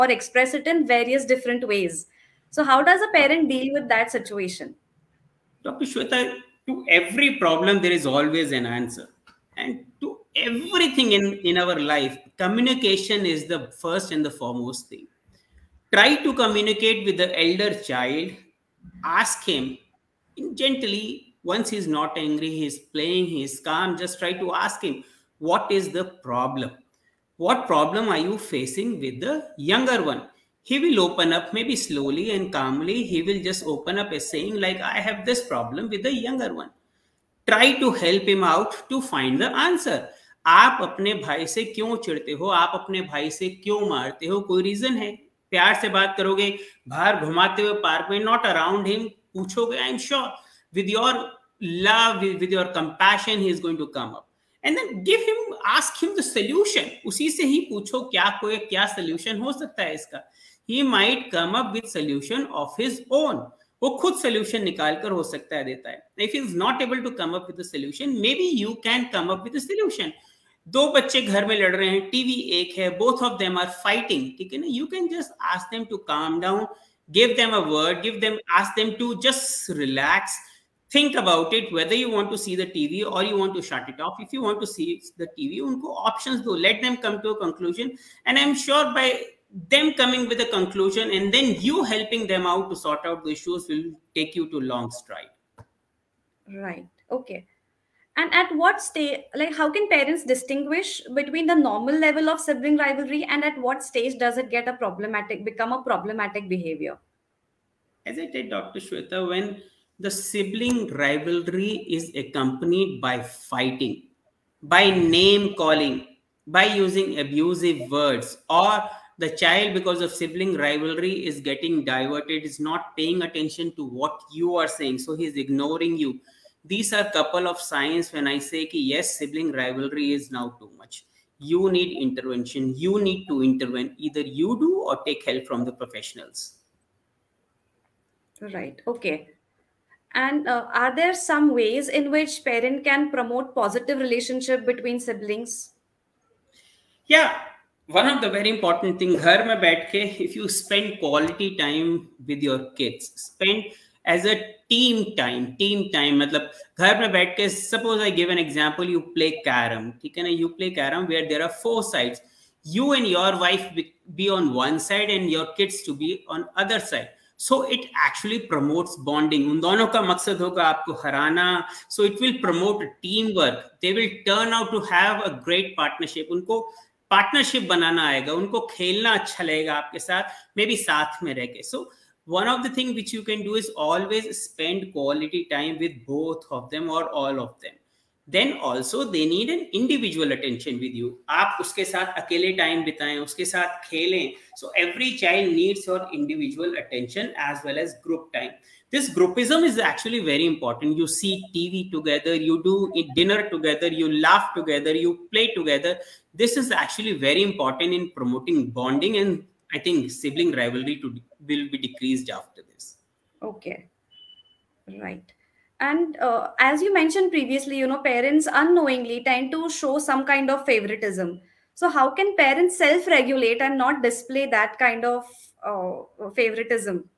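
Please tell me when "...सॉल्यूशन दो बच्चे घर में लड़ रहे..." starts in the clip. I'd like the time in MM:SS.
01:09.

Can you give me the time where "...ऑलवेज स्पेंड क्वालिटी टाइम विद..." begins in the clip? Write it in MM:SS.
03:03.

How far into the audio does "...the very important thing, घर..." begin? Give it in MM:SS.
02:28.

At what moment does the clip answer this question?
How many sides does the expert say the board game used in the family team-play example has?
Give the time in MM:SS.
02:41.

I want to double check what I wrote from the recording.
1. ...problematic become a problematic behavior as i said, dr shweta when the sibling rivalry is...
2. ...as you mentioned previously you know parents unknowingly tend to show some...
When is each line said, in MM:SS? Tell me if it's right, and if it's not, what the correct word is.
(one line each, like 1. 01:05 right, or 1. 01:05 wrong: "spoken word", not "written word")
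1. 01:44 right
2. 03:36 right.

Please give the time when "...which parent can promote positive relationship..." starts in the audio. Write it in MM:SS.
02:22.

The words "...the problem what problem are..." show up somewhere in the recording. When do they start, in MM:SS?
00:25.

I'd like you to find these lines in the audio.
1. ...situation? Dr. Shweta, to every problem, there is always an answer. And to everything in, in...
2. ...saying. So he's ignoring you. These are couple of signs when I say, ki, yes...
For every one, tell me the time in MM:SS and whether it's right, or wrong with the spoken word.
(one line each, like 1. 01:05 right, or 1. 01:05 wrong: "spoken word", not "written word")
1. 00:04 right
2. 02:04 right.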